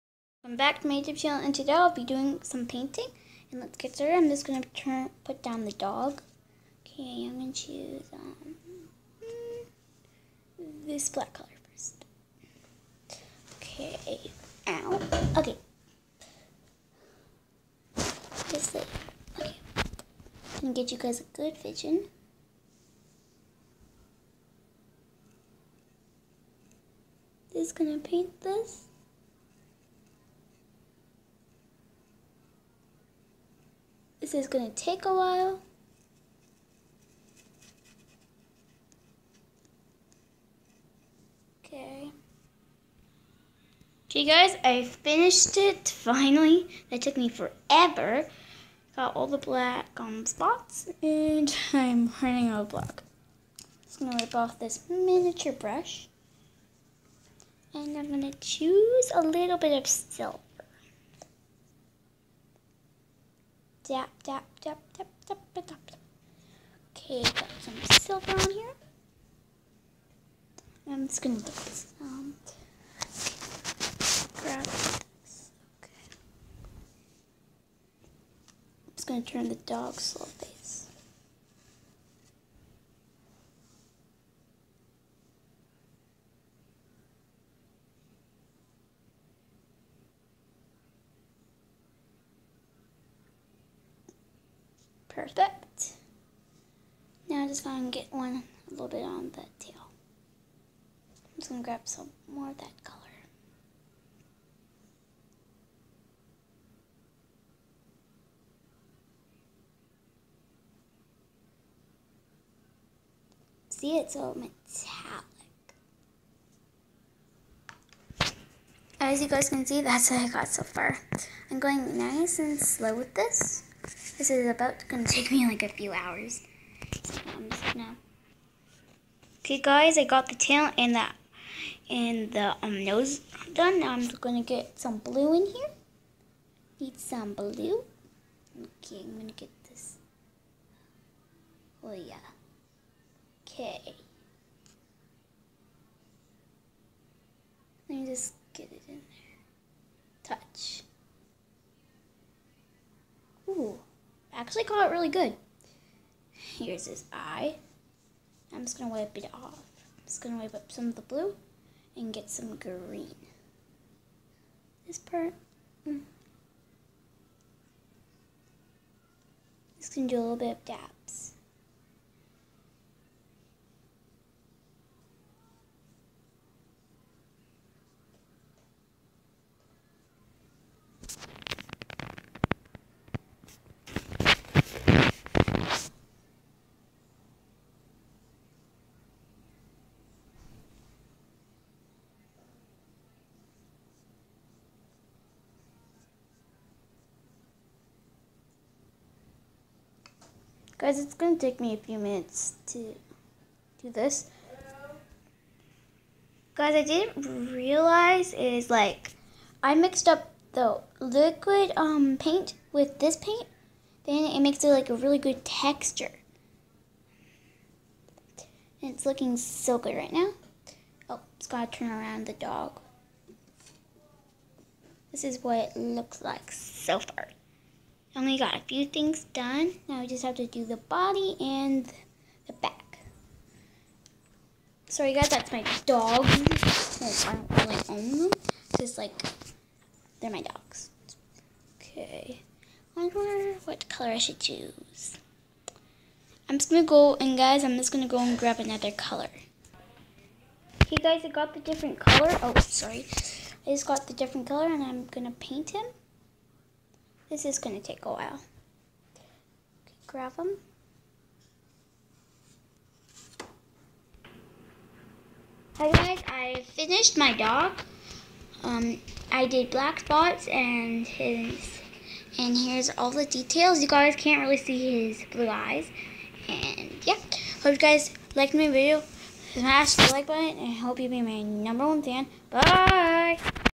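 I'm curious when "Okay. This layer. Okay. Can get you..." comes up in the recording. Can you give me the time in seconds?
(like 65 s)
15 s.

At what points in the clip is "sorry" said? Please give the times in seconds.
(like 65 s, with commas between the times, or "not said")
234 s, 252 s.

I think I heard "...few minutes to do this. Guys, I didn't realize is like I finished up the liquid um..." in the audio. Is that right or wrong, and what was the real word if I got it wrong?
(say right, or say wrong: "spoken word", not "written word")
wrong: "mixed", not "finished".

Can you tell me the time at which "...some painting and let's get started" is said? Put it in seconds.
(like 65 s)
2 s.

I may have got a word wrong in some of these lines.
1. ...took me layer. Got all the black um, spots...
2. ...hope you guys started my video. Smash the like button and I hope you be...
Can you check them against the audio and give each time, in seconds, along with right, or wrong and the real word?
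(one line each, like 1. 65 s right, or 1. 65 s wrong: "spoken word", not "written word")
1. 47 s wrong: "forever", not "layer"
2. 277 s wrong: "liked", not "started".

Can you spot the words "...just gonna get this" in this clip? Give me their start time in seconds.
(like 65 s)
71 s.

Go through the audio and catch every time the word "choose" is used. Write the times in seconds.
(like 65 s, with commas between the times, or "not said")
7 s, 58 s, 244 s.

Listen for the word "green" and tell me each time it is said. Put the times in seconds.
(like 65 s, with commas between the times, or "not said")
162 s.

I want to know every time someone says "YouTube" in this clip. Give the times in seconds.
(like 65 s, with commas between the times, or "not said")
0 s.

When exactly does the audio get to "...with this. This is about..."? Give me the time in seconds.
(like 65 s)
122 s.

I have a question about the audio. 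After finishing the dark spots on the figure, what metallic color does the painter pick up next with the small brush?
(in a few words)
silver.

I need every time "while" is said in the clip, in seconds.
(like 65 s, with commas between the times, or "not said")
35 s, 258 s.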